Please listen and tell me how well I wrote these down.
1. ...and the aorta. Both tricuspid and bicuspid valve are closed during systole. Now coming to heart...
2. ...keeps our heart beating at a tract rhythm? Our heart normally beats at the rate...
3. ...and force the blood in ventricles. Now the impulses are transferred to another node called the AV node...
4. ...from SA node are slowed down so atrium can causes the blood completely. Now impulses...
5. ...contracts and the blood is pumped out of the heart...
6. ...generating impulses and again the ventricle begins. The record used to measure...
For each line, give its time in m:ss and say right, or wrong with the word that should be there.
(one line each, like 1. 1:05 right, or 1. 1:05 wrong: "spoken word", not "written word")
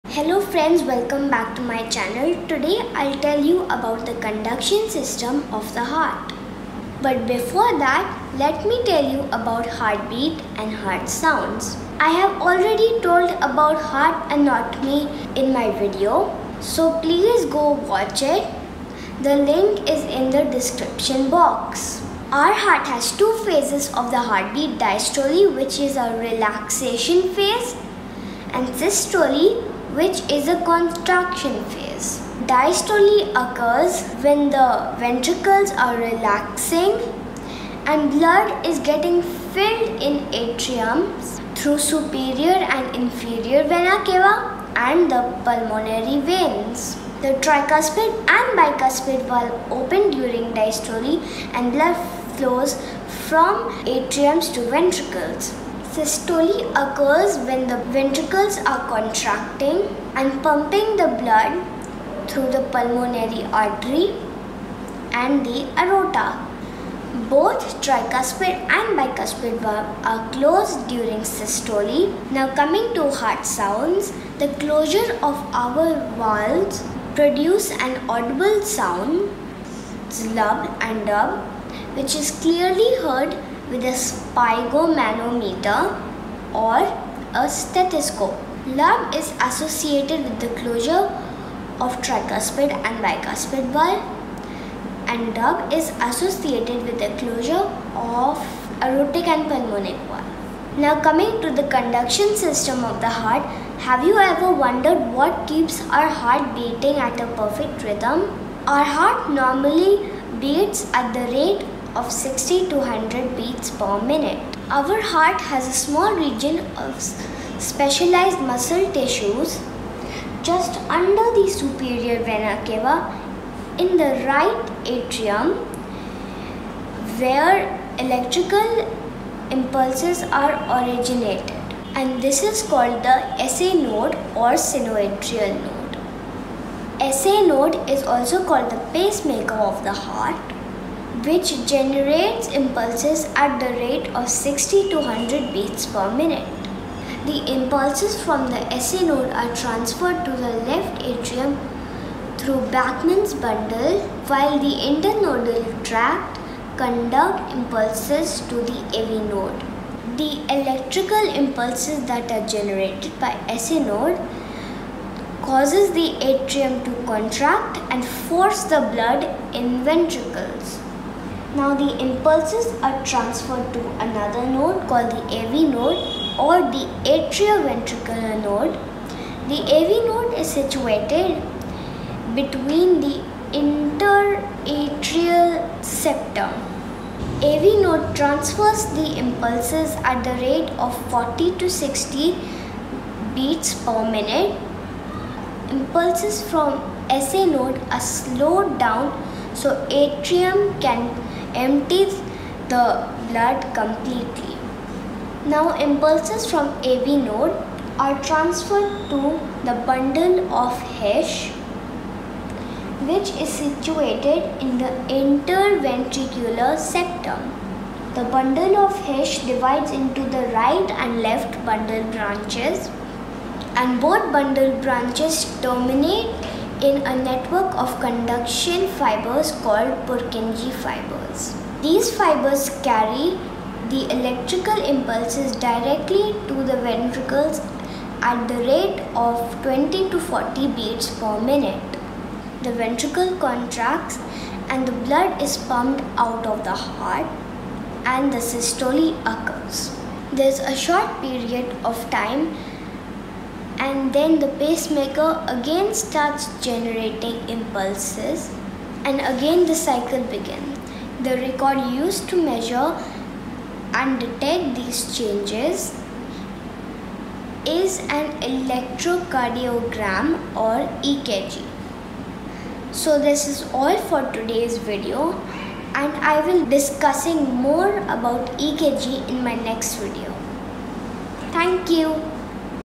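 1. 1:05 right
2. 1:45 wrong: "perfect", not "tract"
3. 2:47 right
4. 3:16 wrong: "empties", not "causes"
5. 4:03 right
6. 4:16 wrong: "cycle", not "ventricle".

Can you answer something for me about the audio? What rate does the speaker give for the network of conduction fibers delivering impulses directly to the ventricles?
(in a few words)
20 to 40 beats per minute.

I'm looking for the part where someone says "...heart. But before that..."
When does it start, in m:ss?
0:05.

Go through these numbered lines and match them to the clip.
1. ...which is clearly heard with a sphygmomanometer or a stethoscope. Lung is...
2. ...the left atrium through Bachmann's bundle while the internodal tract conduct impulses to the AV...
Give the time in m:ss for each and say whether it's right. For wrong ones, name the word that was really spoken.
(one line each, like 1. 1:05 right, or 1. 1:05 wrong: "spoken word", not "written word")
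1. 1:21 right
2. 2:30 right.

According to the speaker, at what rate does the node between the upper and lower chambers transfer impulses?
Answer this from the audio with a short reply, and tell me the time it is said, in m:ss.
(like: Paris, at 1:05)
40 to 60 beats per minute, at 3:11.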